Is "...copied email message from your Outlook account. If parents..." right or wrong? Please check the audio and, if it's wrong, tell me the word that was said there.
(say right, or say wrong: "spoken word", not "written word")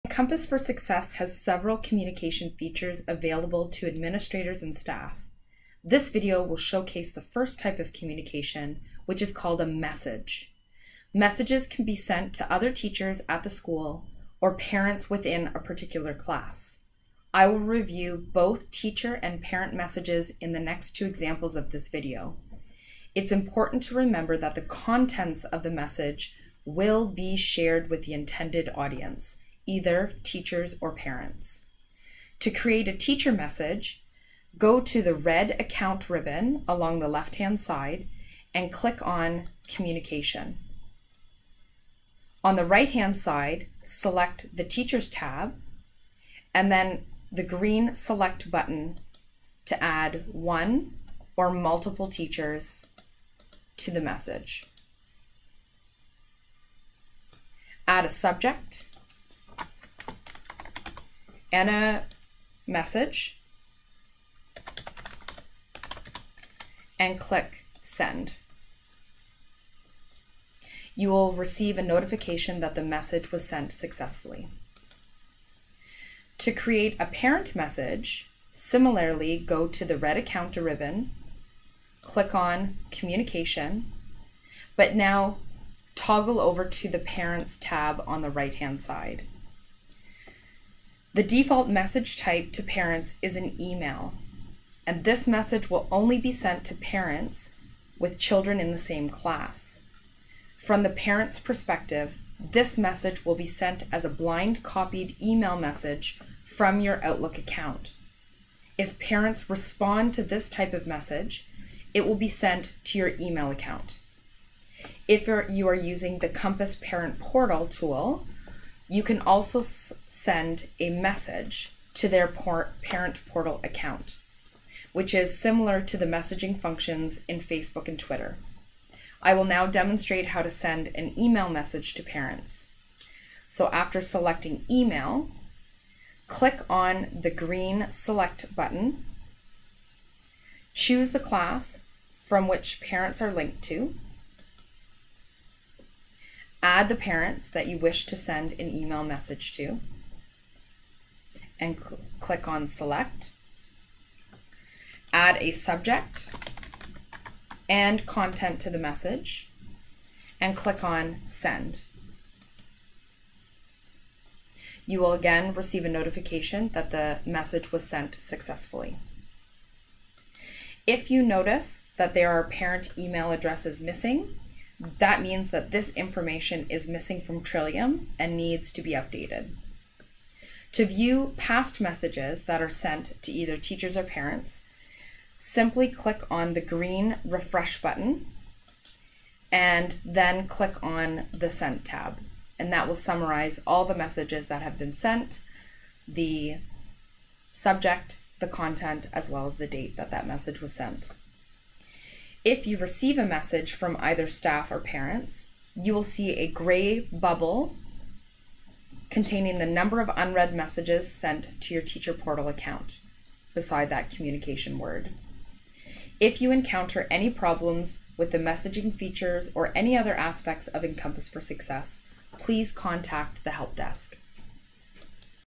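right.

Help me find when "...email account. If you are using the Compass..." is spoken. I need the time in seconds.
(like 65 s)
113 s.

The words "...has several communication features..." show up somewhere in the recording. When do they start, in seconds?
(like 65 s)
1 s.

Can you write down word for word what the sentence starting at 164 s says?
You will again receive a notification that the message was sent successfully.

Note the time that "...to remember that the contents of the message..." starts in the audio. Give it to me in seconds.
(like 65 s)
23 s.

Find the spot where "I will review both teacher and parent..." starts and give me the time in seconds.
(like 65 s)
17 s.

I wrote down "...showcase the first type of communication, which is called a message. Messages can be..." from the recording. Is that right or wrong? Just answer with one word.
right.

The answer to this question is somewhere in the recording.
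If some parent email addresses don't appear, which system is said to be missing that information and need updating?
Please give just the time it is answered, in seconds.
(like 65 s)
177 s.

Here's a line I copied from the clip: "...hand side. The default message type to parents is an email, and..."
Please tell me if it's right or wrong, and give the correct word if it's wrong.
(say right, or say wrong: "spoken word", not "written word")
right.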